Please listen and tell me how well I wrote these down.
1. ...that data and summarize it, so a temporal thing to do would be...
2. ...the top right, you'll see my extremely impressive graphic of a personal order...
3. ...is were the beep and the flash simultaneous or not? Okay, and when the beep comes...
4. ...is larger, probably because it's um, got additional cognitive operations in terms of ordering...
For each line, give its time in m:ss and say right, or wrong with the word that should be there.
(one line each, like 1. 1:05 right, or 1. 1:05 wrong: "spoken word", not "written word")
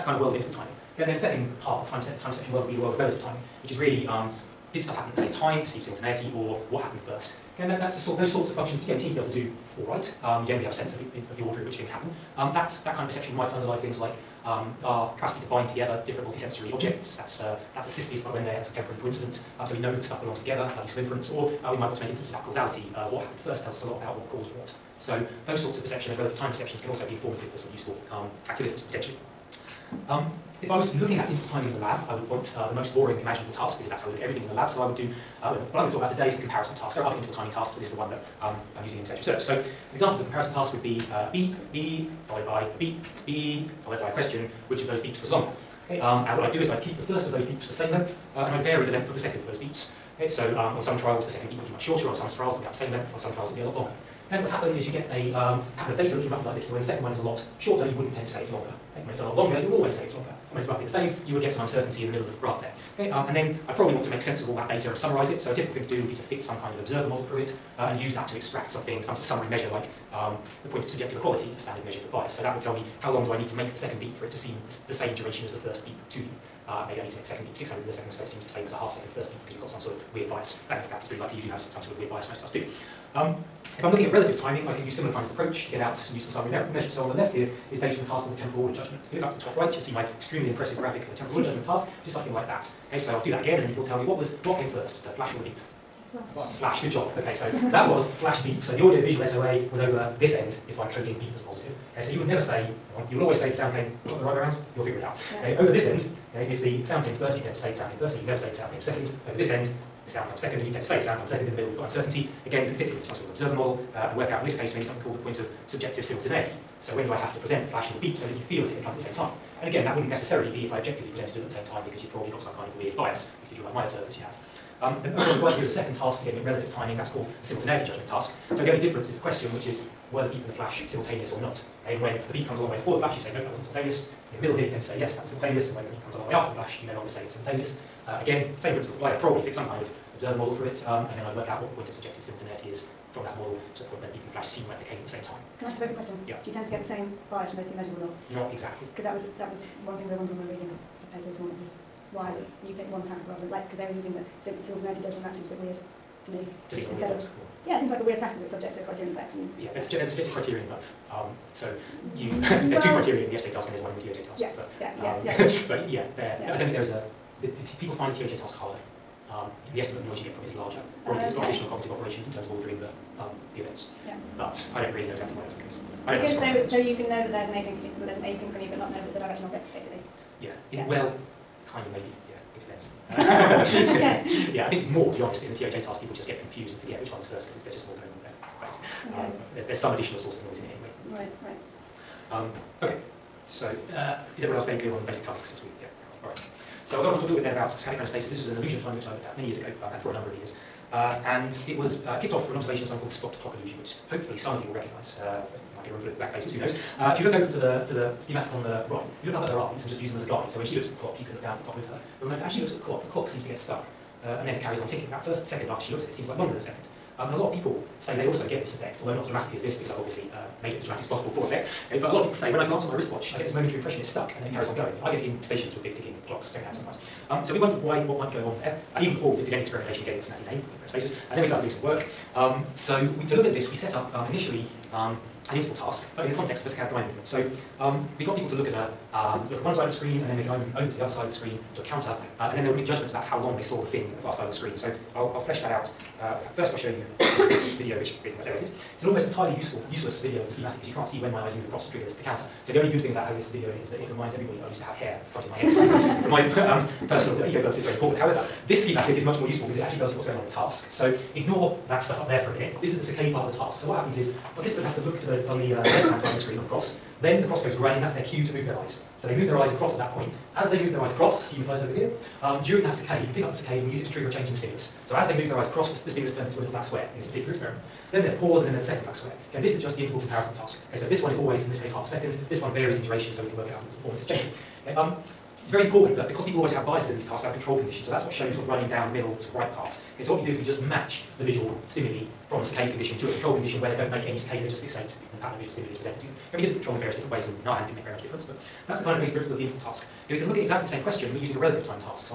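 1. 1:04 wrong: "typical", not "temporal"
2. 1:29 wrong: "temporal", not "personal"
3. 2:09 right
4. 2:50 right.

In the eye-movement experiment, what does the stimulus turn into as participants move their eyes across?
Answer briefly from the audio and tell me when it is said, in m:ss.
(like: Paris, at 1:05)
a little black square, at 4:36.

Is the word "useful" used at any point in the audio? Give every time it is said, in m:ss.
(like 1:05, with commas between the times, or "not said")
0:20, 0:27, 1:26, 4:09, 4:19.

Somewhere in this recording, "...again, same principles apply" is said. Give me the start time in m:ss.
2:18.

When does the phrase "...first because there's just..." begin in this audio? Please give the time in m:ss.
3:07.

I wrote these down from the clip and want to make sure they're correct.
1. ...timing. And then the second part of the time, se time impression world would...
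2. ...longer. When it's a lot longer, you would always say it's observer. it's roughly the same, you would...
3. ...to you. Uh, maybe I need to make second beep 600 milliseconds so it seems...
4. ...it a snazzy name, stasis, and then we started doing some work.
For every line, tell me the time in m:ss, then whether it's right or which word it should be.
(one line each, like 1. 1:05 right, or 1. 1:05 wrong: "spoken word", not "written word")
1. 0:00 wrong: "section", not "impression"
2. 0:58 wrong: "longer", not "observer"
3. 1:16 right
4. 3:50 right.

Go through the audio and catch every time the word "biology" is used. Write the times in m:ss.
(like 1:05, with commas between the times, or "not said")
not said.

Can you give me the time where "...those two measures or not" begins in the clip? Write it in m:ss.
2:27.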